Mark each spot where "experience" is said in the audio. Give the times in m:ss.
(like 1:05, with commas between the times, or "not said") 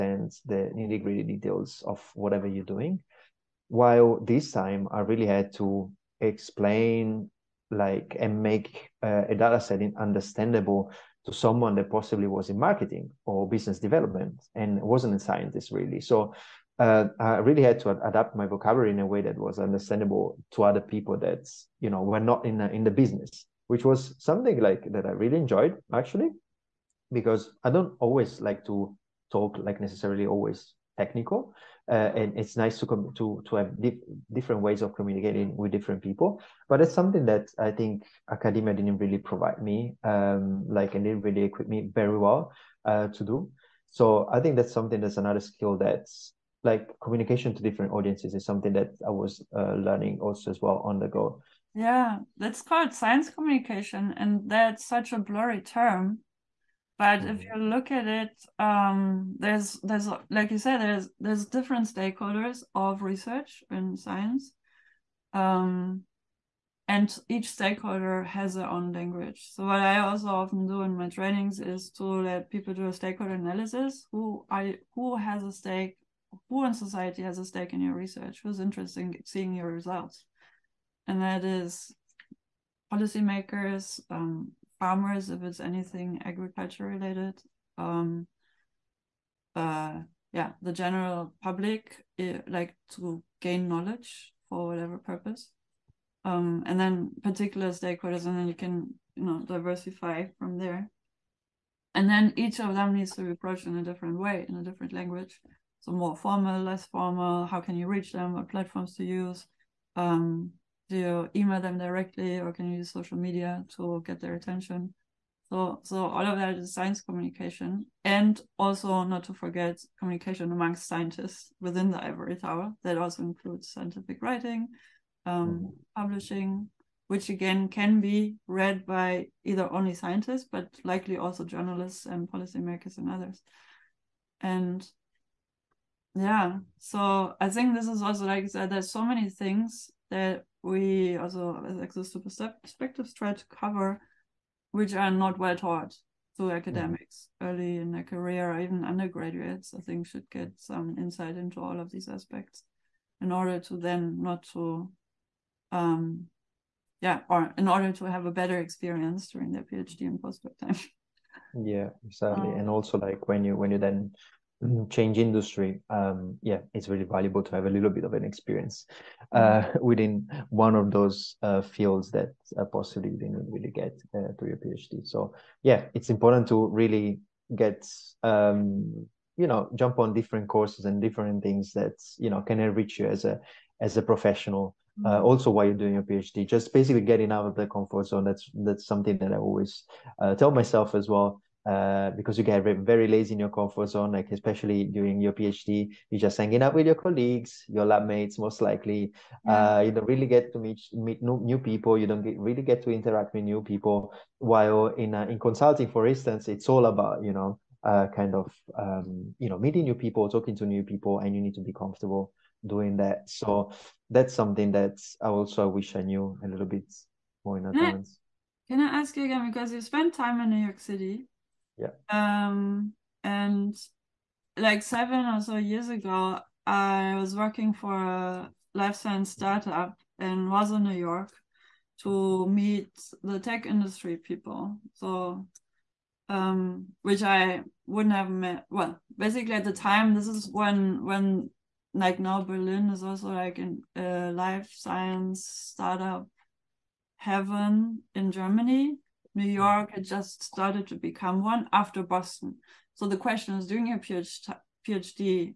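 2:38, 2:48.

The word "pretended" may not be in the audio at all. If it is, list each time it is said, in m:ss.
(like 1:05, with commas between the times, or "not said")
not said.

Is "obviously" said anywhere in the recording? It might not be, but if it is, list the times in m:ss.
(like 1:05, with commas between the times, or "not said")
not said.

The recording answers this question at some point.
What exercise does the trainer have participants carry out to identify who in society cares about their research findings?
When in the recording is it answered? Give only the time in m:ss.
1:12.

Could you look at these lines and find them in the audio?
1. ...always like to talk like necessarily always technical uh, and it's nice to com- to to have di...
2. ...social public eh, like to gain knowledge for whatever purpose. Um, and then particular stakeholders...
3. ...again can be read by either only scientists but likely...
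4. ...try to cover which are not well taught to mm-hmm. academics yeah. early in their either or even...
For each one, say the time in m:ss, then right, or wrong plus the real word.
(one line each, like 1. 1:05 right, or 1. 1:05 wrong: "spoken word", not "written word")
1. 0:28 right
2. 1:30 wrong: "general", not "social"
3. 2:07 right
4. 2:23 wrong: "career", not "either".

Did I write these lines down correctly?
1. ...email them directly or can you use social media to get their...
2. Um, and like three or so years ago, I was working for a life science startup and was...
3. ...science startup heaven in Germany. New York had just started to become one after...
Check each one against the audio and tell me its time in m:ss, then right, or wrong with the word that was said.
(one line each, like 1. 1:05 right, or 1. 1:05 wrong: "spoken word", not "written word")
1. 1:51 right
2. 3:42 wrong: "seven", not "three"
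3. 4:04 right.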